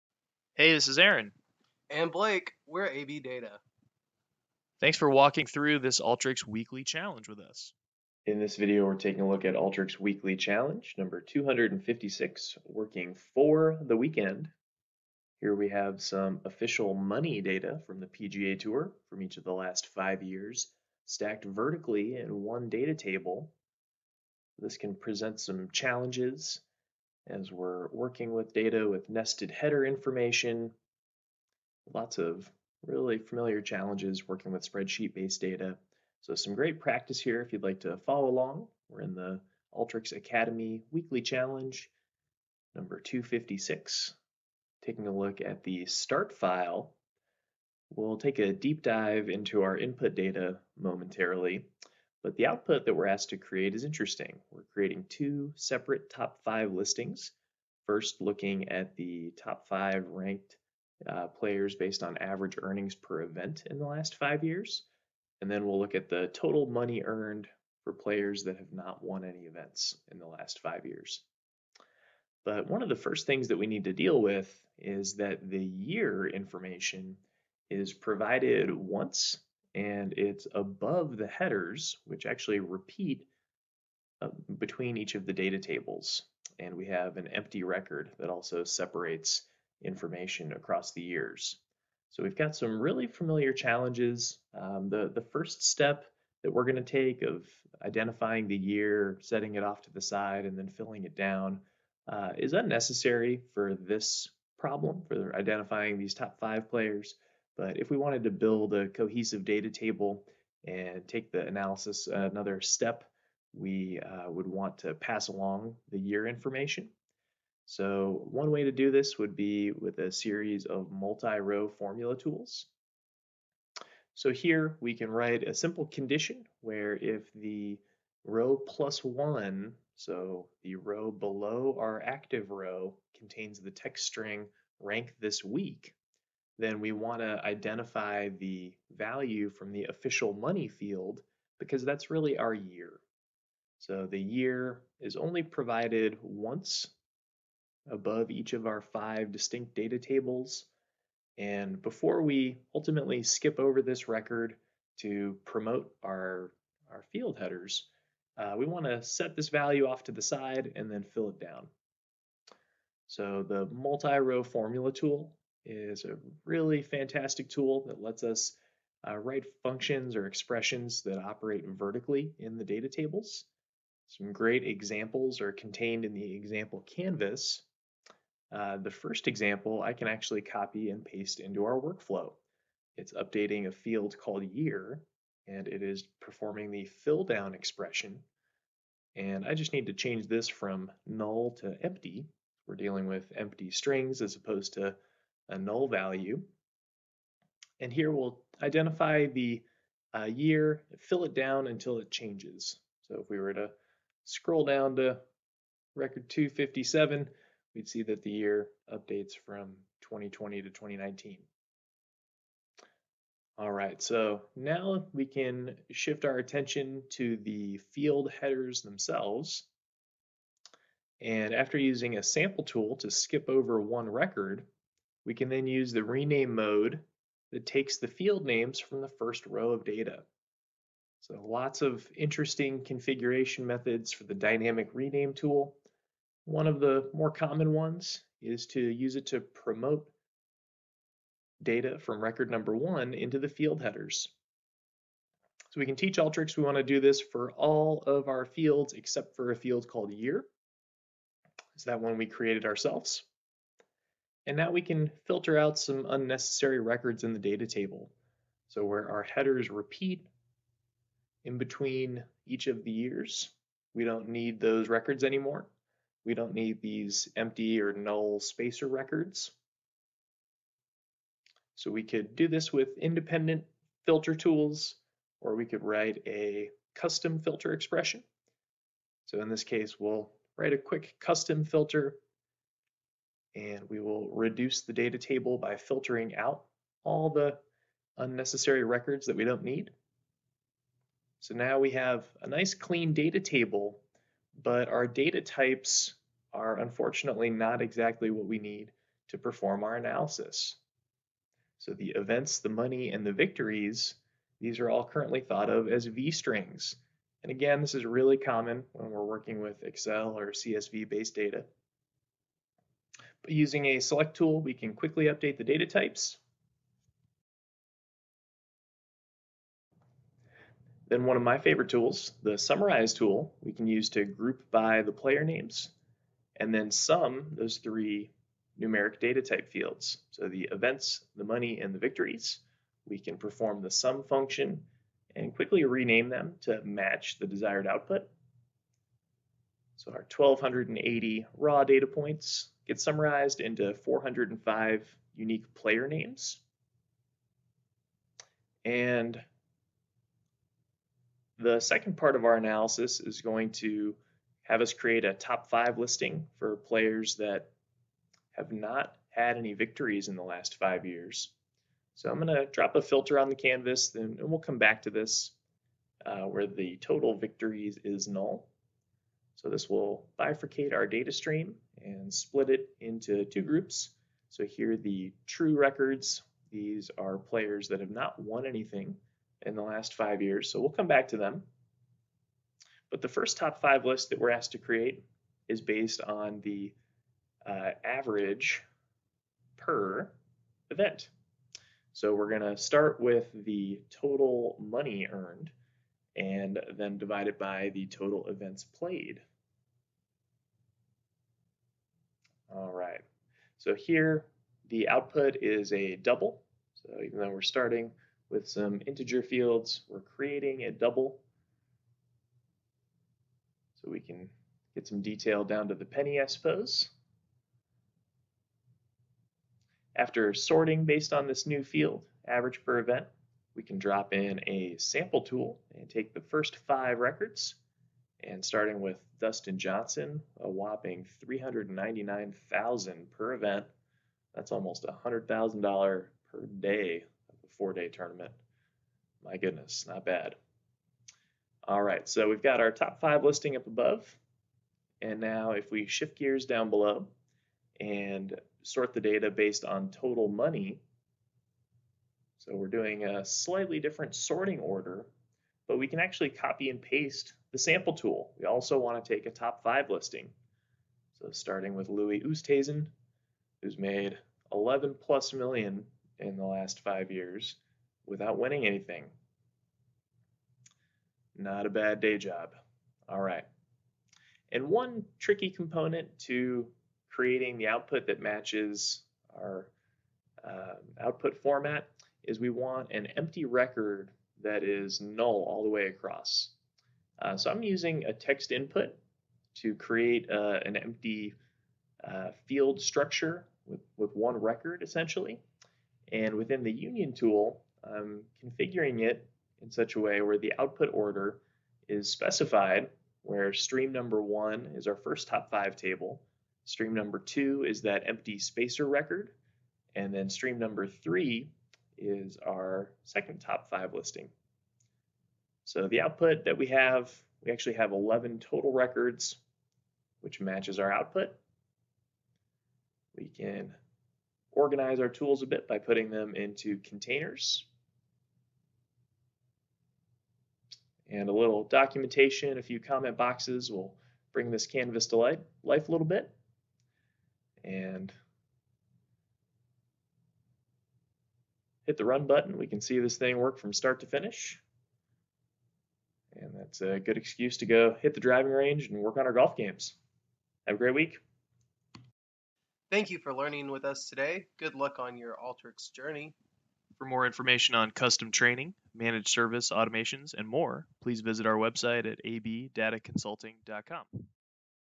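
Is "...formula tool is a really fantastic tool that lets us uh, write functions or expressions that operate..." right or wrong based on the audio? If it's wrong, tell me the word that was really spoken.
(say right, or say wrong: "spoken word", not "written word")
right.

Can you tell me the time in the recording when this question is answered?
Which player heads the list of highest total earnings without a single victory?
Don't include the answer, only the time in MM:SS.
07:42.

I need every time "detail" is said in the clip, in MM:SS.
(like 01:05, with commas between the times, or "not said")
06:55.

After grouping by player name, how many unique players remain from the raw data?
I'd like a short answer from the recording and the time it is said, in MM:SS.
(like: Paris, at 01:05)
405, at 05:44.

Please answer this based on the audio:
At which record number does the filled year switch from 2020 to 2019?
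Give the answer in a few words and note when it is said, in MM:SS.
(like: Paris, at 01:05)
257, at 03:26.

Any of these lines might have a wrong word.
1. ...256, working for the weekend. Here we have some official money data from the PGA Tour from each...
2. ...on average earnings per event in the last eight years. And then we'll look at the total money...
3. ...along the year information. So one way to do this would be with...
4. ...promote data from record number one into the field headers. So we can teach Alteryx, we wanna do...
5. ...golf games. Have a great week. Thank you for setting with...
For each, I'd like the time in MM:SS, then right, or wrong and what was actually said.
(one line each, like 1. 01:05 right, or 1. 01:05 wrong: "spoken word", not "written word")
1. 00:11 right
2. 01:02 wrong: "five", not "eight"
3. 01:55 right
4. 03:59 right
5. 09:09 wrong: "learning", not "setting".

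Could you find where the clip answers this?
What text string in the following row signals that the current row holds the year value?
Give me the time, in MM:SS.
02:14.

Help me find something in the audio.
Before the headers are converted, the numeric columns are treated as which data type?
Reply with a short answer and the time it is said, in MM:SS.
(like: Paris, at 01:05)
V strings, at 05:06.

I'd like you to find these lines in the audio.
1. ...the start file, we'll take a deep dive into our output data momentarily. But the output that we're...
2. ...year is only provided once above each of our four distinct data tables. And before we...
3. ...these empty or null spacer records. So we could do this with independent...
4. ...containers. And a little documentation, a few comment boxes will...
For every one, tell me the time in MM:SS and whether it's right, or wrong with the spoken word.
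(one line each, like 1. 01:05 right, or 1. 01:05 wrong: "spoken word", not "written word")
1. 00:45 wrong: "input", not "output"
2. 02:24 wrong: "five", not "four"
3. 04:26 right
4. 08:47 right.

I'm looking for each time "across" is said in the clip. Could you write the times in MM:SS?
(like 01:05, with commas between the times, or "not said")
01:30, 08:06.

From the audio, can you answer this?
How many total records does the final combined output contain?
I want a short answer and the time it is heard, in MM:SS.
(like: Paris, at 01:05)
11, at 08:38.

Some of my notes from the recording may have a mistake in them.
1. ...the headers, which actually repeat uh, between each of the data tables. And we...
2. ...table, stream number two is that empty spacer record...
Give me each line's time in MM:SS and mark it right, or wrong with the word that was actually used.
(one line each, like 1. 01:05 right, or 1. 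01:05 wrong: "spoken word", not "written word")
1. 01:21 right
2. 08:25 right.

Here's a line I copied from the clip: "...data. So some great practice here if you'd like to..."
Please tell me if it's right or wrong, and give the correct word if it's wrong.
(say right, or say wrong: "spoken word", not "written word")
right.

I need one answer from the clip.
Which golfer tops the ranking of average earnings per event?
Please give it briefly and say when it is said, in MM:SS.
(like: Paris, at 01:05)
Dustin Johnson, at 07:09.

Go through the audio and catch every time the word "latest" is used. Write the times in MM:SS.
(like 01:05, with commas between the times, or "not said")
not said.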